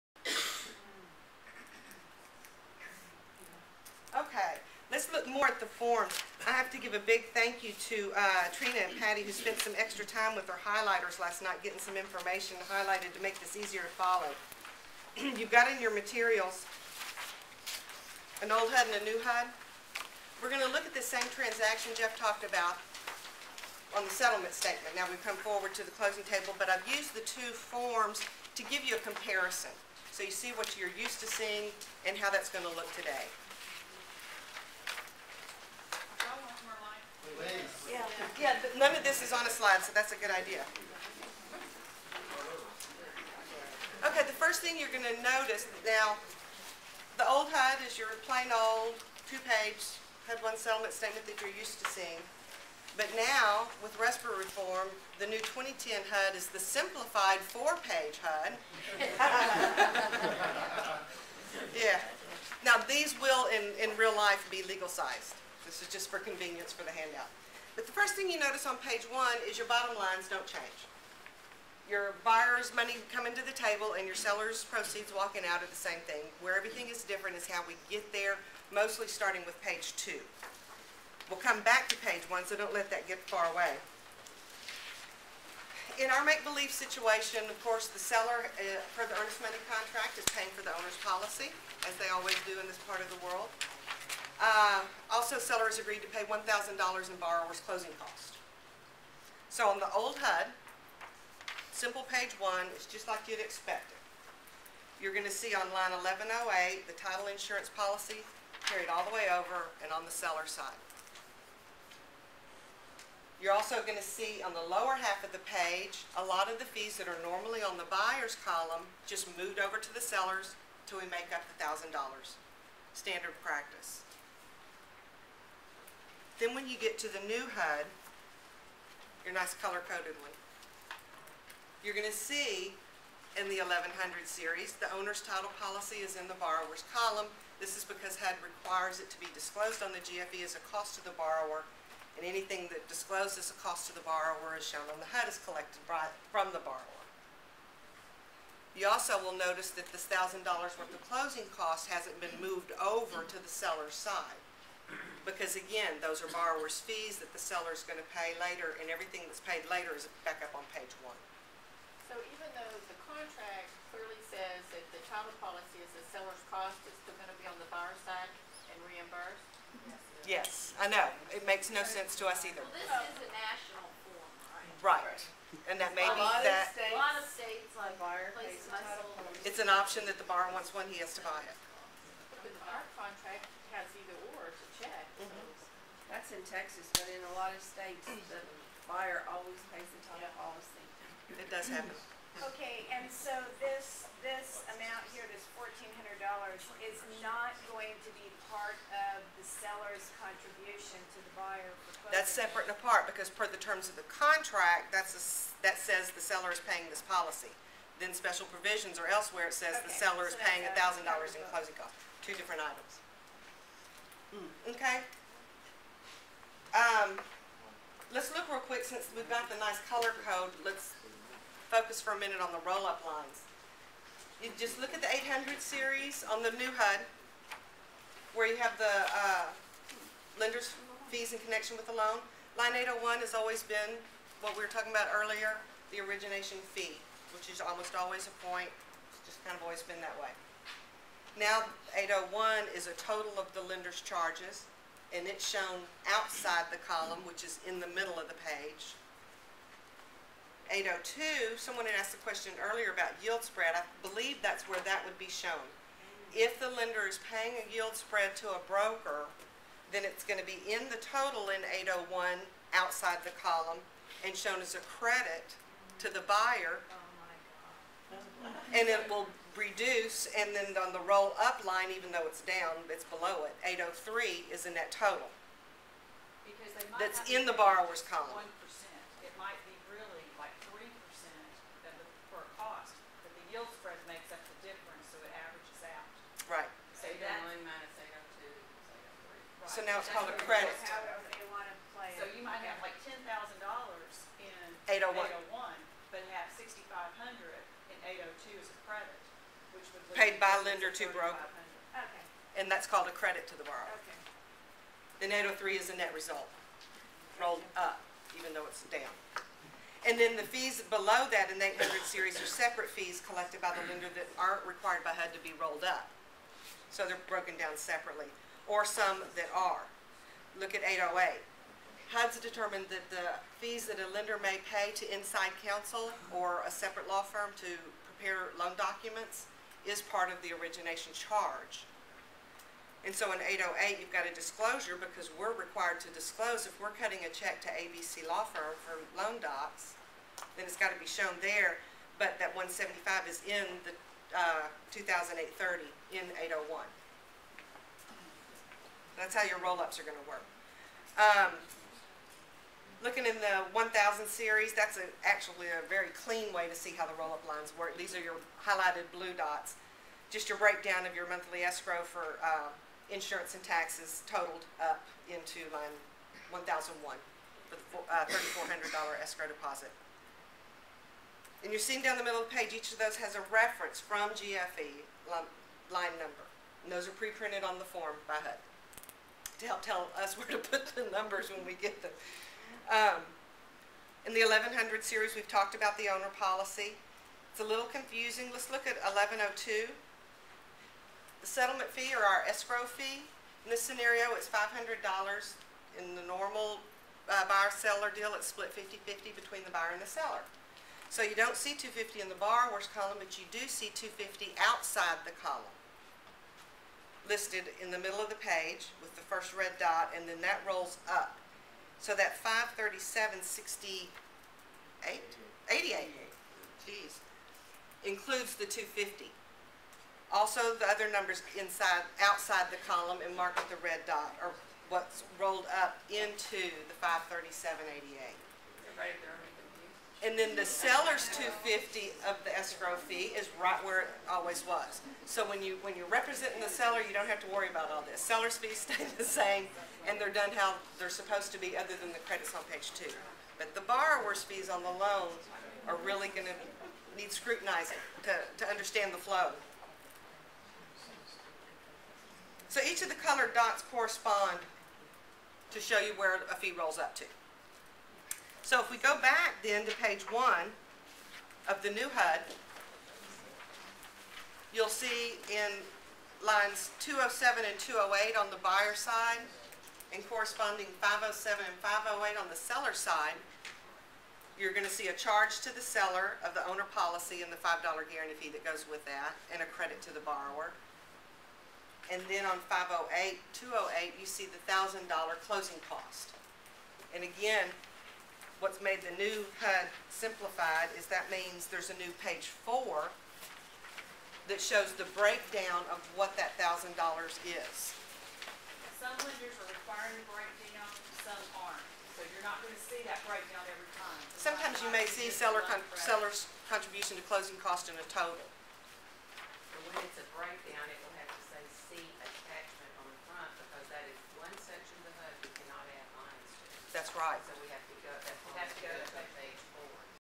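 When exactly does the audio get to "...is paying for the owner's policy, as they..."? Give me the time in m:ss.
1:30.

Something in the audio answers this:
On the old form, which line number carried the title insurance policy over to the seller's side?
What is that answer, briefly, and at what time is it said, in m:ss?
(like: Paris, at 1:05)
1108, at 1:46.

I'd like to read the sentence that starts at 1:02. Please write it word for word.
Now, these will, in, in real life, be legal-sized.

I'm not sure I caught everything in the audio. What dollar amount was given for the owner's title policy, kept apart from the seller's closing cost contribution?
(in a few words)
$1,400.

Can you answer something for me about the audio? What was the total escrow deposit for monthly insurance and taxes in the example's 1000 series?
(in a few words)
$3,400.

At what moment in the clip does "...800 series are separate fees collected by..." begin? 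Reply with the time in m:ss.
5:11.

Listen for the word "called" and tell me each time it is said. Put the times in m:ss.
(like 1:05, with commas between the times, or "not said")
4:50, 5:02.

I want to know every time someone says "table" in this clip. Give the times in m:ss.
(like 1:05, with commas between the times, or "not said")
0:26, 1:13.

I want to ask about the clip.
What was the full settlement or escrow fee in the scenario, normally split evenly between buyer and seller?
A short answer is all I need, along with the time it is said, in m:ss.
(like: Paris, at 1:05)
$500, at 6:34.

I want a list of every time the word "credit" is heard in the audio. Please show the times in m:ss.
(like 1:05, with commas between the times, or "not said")
4:24, 4:50, 5:03, 7:22, 7:59, 8:25.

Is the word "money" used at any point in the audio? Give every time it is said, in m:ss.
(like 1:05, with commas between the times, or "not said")
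1:12, 1:29.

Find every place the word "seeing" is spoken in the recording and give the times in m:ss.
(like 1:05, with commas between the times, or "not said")
0:31, 0:51, 6:11.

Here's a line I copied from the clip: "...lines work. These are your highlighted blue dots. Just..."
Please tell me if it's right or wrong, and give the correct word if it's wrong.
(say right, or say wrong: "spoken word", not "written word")
right.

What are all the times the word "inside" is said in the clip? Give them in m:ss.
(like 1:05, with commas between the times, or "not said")
5:25, 7:01.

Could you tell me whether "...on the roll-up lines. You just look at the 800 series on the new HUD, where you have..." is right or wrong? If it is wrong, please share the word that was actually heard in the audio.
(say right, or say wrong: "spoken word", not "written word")
right.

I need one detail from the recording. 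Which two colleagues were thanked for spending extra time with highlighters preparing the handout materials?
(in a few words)
Trina and Patty.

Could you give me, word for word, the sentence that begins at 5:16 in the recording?
So they're broken down separately, or some that are.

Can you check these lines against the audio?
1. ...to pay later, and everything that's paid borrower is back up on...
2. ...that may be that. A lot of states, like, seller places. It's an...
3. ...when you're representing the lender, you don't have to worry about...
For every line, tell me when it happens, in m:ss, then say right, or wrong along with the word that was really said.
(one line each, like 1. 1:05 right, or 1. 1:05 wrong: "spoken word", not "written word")
1. 2:38 wrong: "later", not "borrower"
2. 2:55 wrong: "buyer", not "seller"
3. 7:15 wrong: "seller", not "lender".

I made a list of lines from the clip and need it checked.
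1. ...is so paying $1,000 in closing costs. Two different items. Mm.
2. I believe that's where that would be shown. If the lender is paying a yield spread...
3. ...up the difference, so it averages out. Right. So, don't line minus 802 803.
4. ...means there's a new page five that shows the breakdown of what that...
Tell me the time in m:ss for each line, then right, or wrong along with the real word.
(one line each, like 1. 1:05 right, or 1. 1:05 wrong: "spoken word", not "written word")
1. 3:30 right
2. 4:13 right
3. 4:44 right
4. 8:11 wrong: "four", not "five".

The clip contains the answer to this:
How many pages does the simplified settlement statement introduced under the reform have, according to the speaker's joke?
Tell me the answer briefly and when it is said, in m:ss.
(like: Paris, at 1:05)
4, at 0:57.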